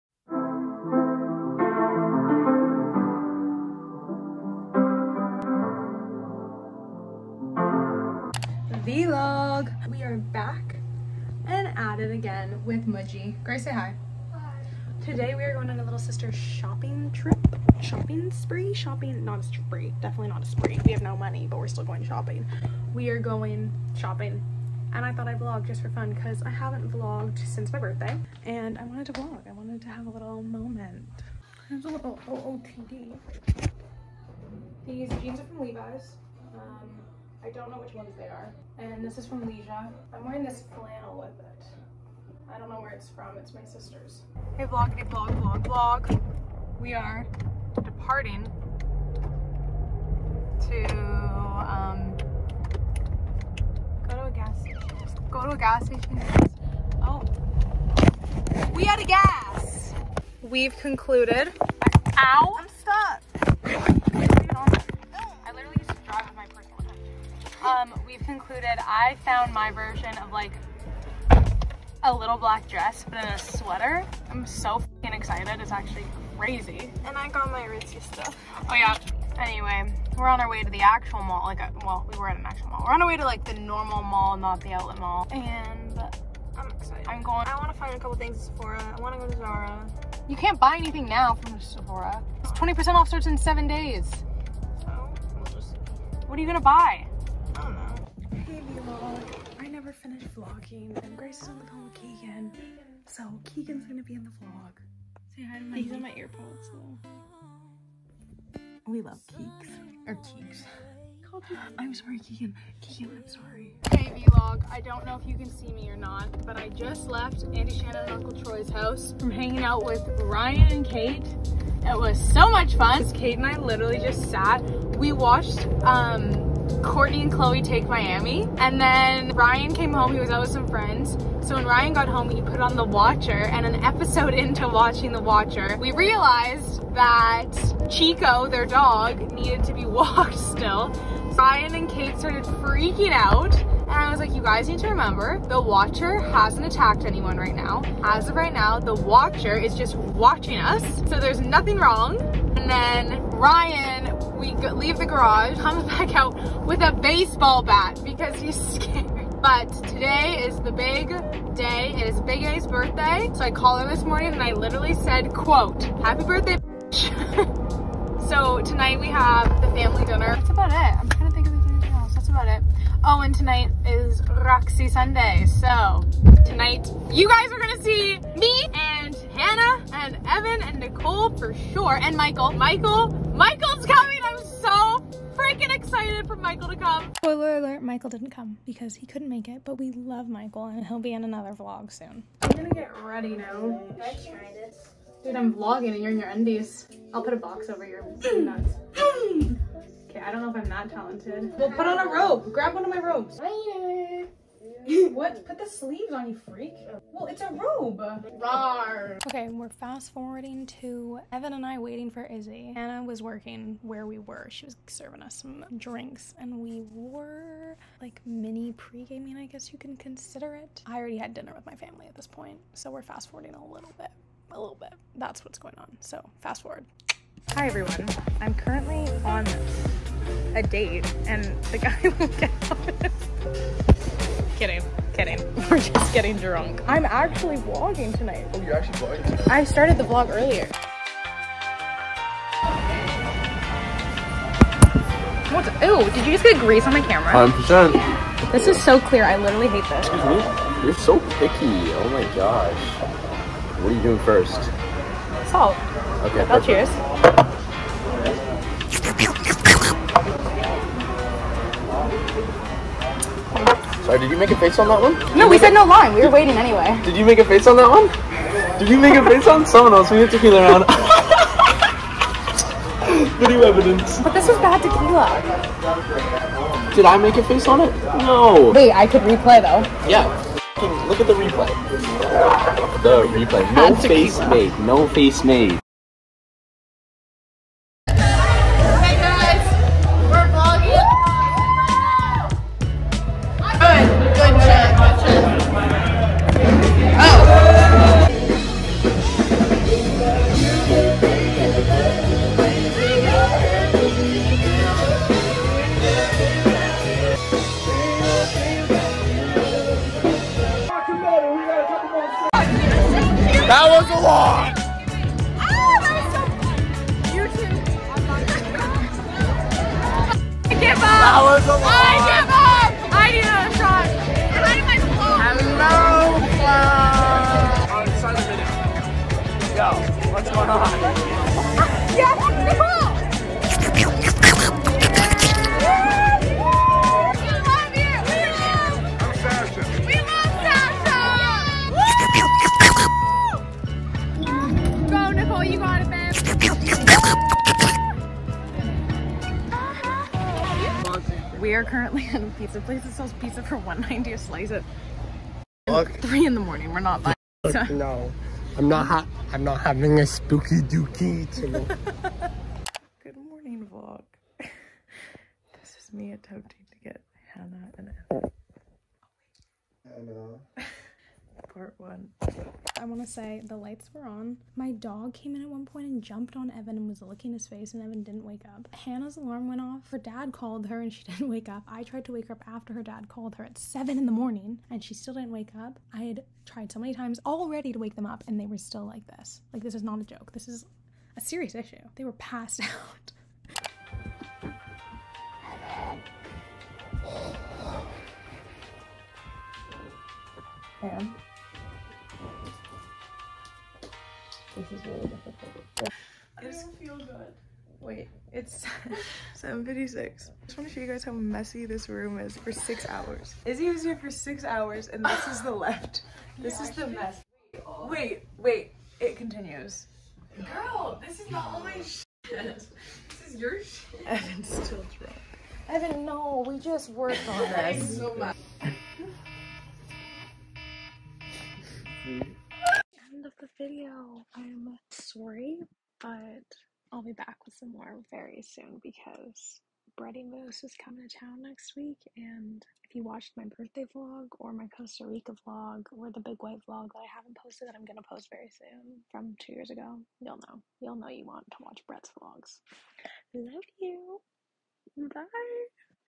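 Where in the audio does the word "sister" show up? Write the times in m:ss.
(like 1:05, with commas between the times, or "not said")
0:15, 0:43.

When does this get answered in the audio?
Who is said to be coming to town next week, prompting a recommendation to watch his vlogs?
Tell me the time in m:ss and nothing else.
7:20.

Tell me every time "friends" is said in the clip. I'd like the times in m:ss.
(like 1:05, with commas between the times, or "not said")
2:10.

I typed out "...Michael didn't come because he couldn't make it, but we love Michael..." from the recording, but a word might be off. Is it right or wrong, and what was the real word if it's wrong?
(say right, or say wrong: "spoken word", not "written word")
right.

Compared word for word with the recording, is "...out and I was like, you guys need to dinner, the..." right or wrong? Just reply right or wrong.
wrong.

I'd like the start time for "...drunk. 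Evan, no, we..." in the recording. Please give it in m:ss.
7:05.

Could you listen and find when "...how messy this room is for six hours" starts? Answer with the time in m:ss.
6:51.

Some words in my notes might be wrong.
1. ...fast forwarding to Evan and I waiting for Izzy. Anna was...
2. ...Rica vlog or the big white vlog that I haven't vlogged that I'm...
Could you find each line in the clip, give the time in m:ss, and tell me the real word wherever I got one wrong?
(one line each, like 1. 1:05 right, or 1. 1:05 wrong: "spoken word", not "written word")
1. 3:29 right
2. 7:25 wrong: "posted", not "vlogged".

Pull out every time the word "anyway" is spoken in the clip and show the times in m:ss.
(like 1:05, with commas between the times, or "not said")
1:19, 4:26.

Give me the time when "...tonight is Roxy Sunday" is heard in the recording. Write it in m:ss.
2:53.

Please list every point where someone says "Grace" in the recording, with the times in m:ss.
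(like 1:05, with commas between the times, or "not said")
0:13, 1:41.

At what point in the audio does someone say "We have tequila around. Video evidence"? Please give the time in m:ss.
4:30.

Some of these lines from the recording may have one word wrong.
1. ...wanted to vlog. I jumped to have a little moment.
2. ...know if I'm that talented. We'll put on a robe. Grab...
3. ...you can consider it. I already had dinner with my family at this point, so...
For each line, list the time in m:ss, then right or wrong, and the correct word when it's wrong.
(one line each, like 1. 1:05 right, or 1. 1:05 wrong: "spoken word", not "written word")
1. 0:28 wrong: "wanted", not "jumped"
2. 3:20 right
3. 3:39 right.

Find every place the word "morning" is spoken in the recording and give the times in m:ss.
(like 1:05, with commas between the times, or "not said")
2:44, 5:56, 6:03, 6:24.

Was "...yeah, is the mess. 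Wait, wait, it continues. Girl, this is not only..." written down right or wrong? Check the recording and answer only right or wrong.
right.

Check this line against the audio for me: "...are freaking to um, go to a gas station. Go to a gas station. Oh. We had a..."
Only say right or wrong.
wrong.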